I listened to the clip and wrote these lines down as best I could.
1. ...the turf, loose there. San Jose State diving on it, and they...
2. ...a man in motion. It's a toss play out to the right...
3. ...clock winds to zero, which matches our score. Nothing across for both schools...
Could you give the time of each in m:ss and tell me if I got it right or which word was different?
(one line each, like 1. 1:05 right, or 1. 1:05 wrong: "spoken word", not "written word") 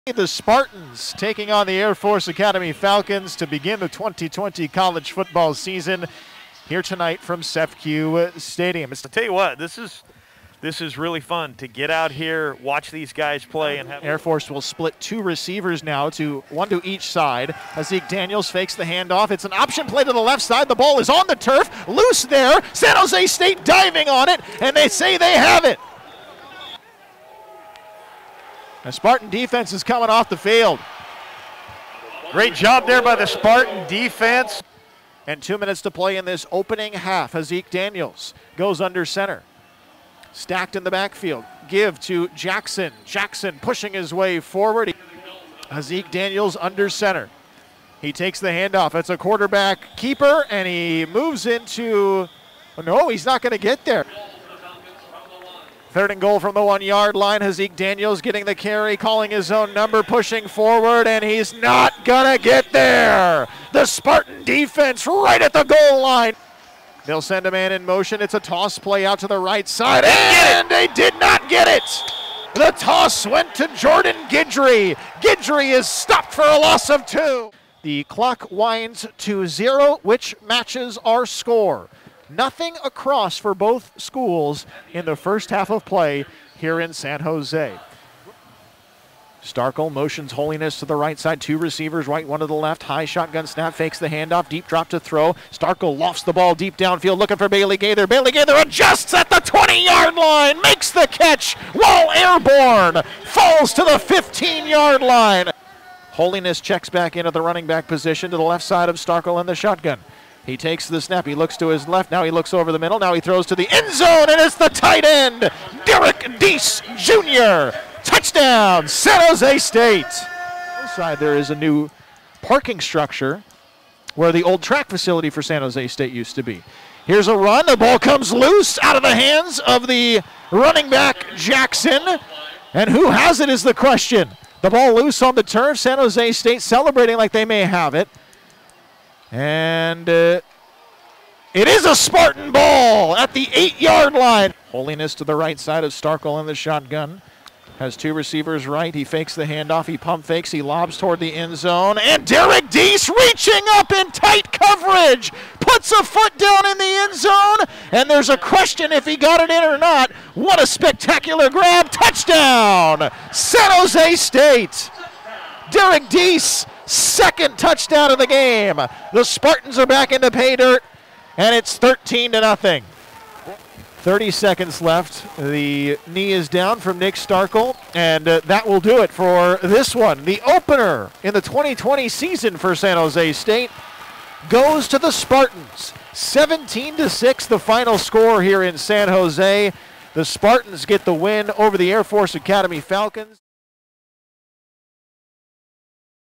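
1. 0:21 right
2. 1:07 right
3. 1:18 right.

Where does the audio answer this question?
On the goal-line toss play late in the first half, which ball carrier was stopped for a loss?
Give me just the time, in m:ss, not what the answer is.
1:13.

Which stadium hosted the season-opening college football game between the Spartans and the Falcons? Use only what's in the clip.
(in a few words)
CEFCU Stadium.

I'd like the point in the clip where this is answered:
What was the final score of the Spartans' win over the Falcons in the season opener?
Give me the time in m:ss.
3:06.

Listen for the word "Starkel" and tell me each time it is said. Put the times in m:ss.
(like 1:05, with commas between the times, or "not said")
1:29, 1:35, 1:48, 2:25, 2:57.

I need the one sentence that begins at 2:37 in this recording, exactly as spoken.
And there's a question if he got it in or not.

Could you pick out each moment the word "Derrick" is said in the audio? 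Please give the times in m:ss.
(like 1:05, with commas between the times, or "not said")
1:55, 2:32, 2:45.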